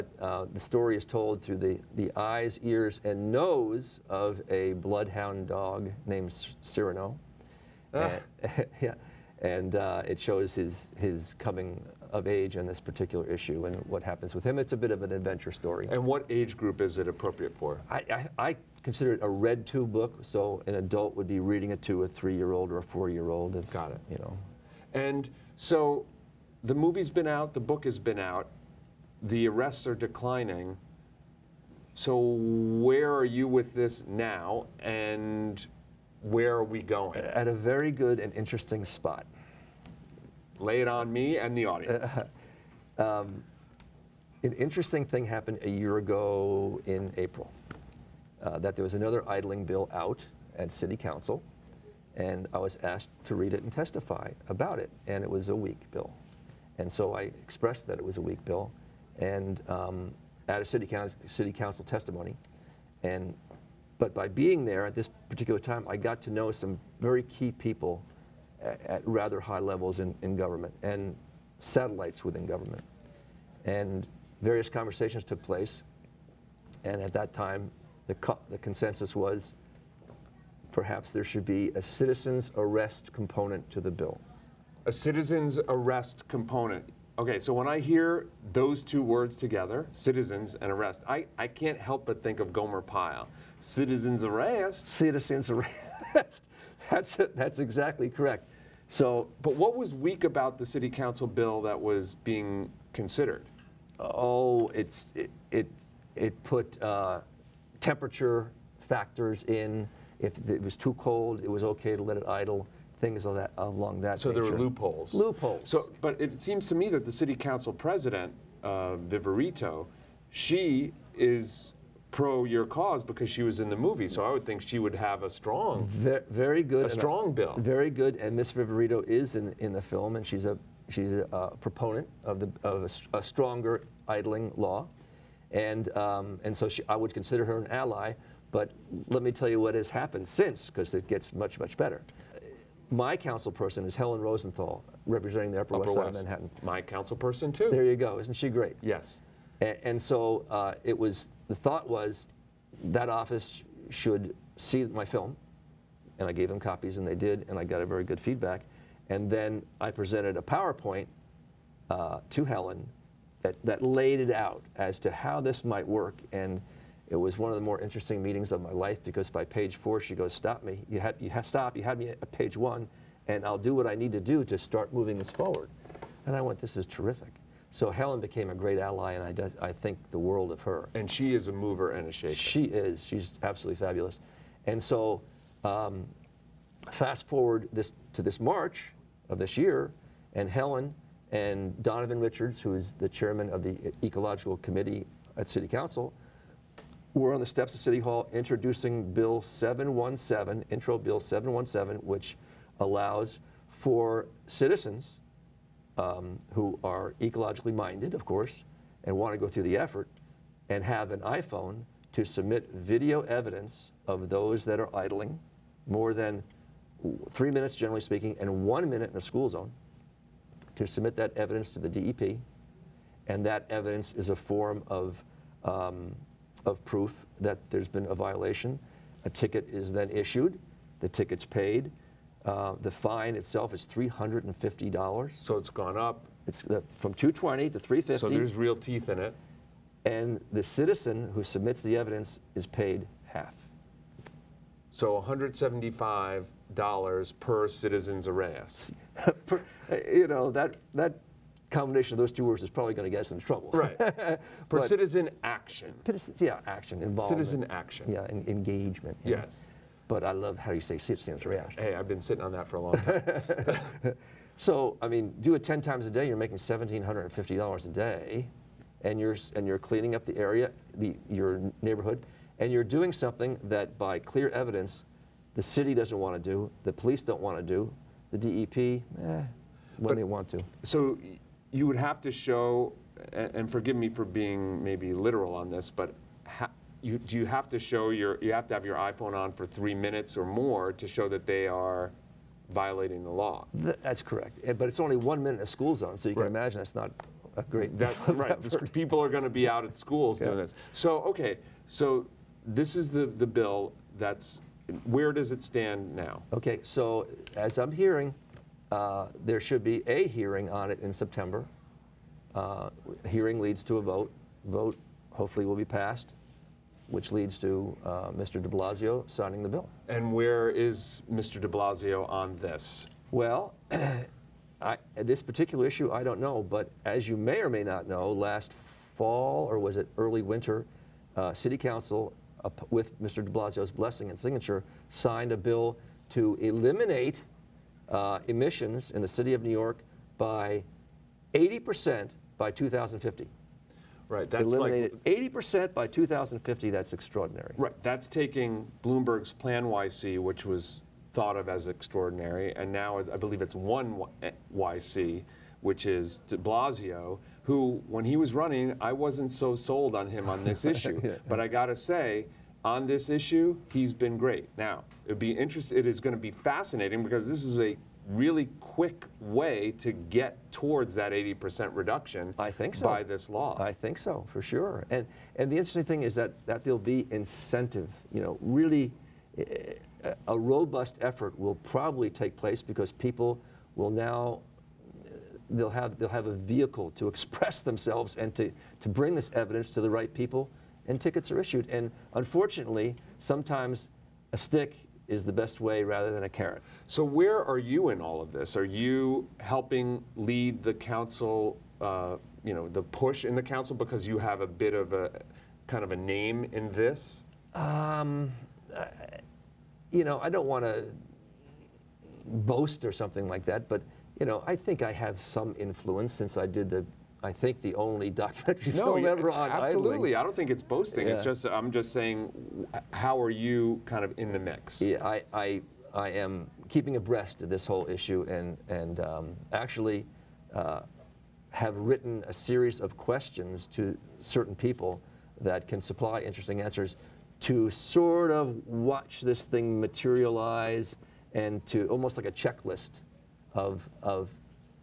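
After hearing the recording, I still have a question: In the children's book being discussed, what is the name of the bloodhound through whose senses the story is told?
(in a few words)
Cyrano.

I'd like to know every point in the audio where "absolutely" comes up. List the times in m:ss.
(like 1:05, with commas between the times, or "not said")
3:03, 6:59.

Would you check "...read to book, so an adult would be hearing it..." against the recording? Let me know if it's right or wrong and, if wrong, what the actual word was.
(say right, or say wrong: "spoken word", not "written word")
wrong: "reading", not "hearing".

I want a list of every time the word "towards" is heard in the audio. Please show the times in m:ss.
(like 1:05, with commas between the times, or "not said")
6:10.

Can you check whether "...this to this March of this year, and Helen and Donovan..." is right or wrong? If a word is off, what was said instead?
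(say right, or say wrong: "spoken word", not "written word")
right.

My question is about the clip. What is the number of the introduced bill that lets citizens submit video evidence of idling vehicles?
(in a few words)
717.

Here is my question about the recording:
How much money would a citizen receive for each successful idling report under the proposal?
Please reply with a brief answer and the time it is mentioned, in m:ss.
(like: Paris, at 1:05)
$175, at 4:05.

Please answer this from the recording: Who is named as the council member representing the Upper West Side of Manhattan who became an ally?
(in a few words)
Helen Rosenthal.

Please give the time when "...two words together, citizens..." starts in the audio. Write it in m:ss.
1:28.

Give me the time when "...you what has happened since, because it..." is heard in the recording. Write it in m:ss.
2:19.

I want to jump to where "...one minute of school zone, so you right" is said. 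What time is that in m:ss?
4:55.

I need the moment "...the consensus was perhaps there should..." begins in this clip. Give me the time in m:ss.
1:18.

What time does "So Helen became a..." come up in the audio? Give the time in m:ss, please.
2:57.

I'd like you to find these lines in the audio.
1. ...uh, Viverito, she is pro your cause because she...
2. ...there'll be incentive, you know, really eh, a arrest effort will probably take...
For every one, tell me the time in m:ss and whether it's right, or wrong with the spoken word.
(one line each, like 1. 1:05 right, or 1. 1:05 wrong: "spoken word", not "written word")
1. 1:58 right
2. 6:16 wrong: "robust", not "arrest".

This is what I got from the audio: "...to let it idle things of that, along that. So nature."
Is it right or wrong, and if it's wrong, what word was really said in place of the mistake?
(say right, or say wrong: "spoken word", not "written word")
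right.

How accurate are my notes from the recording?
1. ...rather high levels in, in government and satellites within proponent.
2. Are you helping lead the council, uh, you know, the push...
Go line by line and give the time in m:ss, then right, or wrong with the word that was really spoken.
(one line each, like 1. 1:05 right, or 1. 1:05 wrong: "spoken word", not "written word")
1. 1:09 wrong: "government", not "proponent"
2. 6:38 right.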